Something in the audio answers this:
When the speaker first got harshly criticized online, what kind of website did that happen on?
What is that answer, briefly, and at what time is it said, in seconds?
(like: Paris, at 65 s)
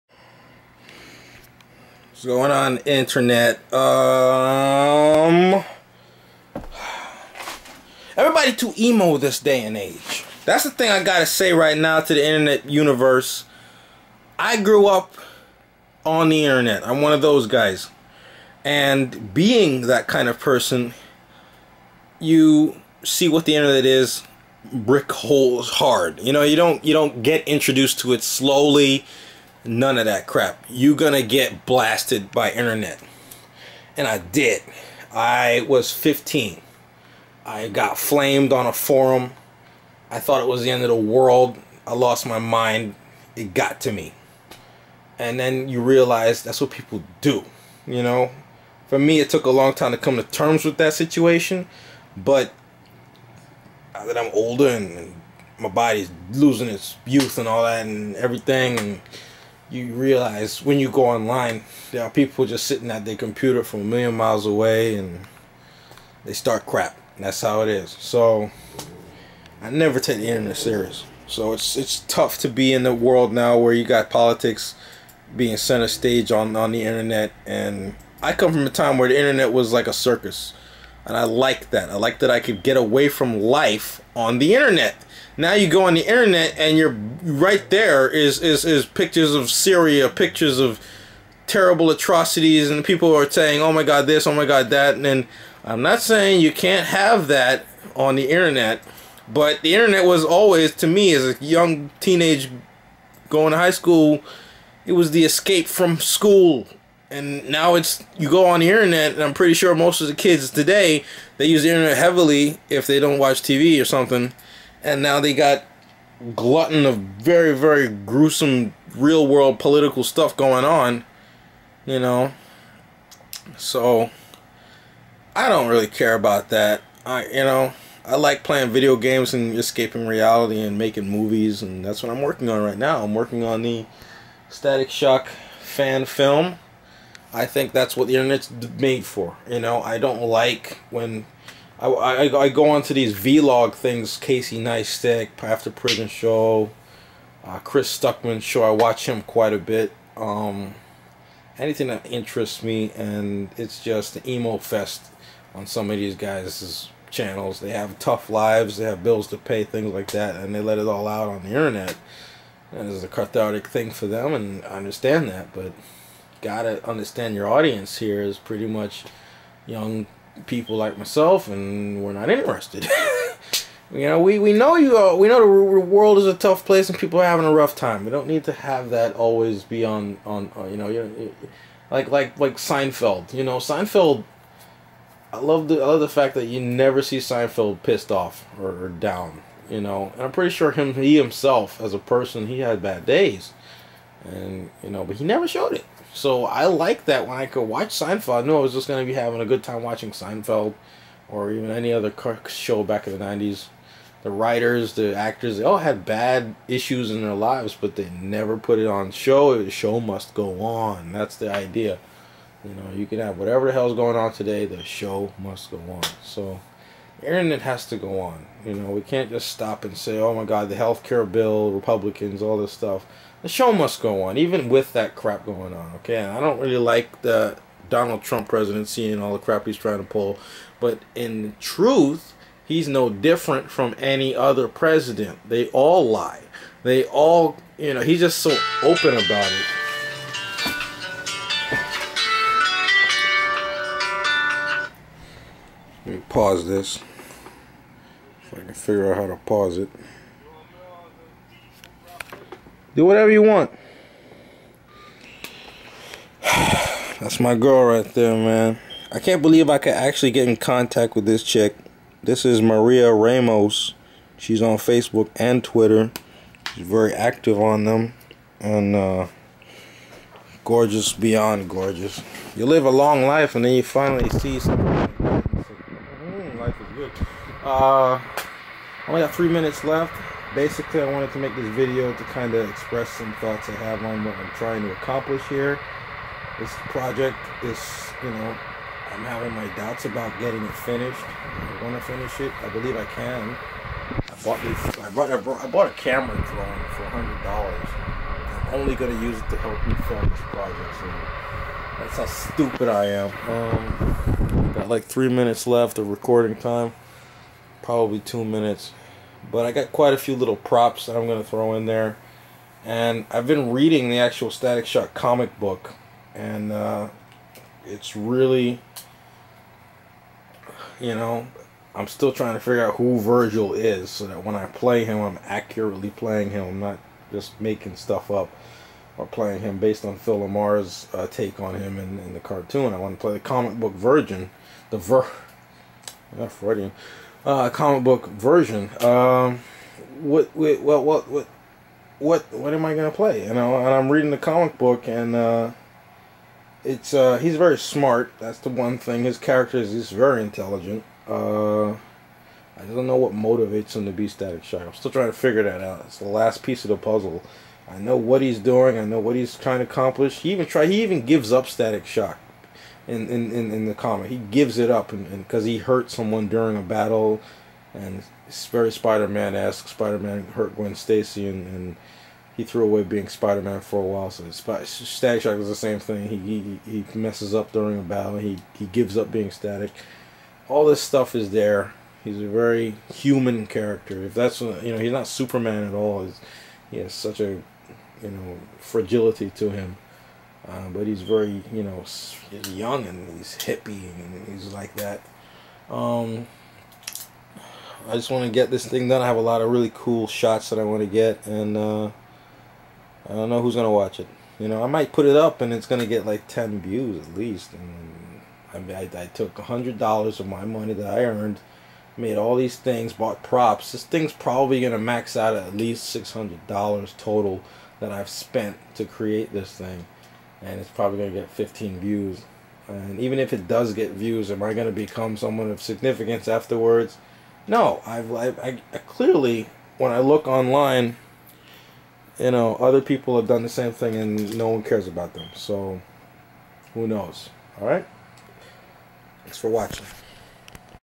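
A forum, at 38 s.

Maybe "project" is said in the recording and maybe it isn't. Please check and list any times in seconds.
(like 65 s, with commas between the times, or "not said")
286 s, 300 s.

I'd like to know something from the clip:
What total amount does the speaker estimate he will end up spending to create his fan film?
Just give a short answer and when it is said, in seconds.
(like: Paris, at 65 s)
$600, at 416 s.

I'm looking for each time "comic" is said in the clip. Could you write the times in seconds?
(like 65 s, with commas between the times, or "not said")
315 s, 333 s, 337 s, 344 s, 363 s.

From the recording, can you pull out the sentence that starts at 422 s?
And even if it does get views, am I going to become someone of significance afterwards?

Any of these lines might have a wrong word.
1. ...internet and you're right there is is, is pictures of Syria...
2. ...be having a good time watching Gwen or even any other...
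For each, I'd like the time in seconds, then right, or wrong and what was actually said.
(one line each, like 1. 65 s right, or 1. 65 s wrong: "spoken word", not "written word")
1. 86 s right
2. 199 s wrong: "Seinfeld", not "Gwen".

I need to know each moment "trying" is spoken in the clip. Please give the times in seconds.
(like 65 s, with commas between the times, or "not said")
229 s, 284 s, 322 s, 355 s, 359 s.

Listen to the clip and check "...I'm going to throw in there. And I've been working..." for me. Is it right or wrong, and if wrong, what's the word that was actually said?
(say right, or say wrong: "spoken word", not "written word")
wrong: "reading", not "working".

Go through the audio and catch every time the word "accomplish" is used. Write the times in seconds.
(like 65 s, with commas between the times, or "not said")
284 s, 359 s.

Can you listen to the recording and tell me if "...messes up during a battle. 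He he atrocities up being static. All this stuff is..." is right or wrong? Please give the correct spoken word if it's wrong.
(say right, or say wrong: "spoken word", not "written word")
wrong: "gives", not "atrocities".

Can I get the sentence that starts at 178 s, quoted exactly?
We don't need to have that always be on on.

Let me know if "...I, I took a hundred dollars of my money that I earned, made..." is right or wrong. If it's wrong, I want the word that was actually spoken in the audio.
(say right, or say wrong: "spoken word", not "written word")
right.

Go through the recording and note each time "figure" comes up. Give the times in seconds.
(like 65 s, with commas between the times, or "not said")
248 s, 322 s, 355 s.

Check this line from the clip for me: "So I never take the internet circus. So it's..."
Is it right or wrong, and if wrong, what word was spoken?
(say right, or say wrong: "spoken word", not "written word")
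wrong: "serious", not "circus".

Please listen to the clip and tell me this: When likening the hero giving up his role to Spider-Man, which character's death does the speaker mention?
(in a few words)
Gwen Stacy.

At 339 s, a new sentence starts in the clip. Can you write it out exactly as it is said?
Um, what, what, what, what, what, what am I gonna play?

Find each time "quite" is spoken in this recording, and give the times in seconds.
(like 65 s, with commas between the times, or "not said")
149 s, 309 s.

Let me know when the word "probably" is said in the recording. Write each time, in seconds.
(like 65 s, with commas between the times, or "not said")
307 s, 414 s, 420 s.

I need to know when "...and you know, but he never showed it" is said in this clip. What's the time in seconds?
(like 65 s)
194 s.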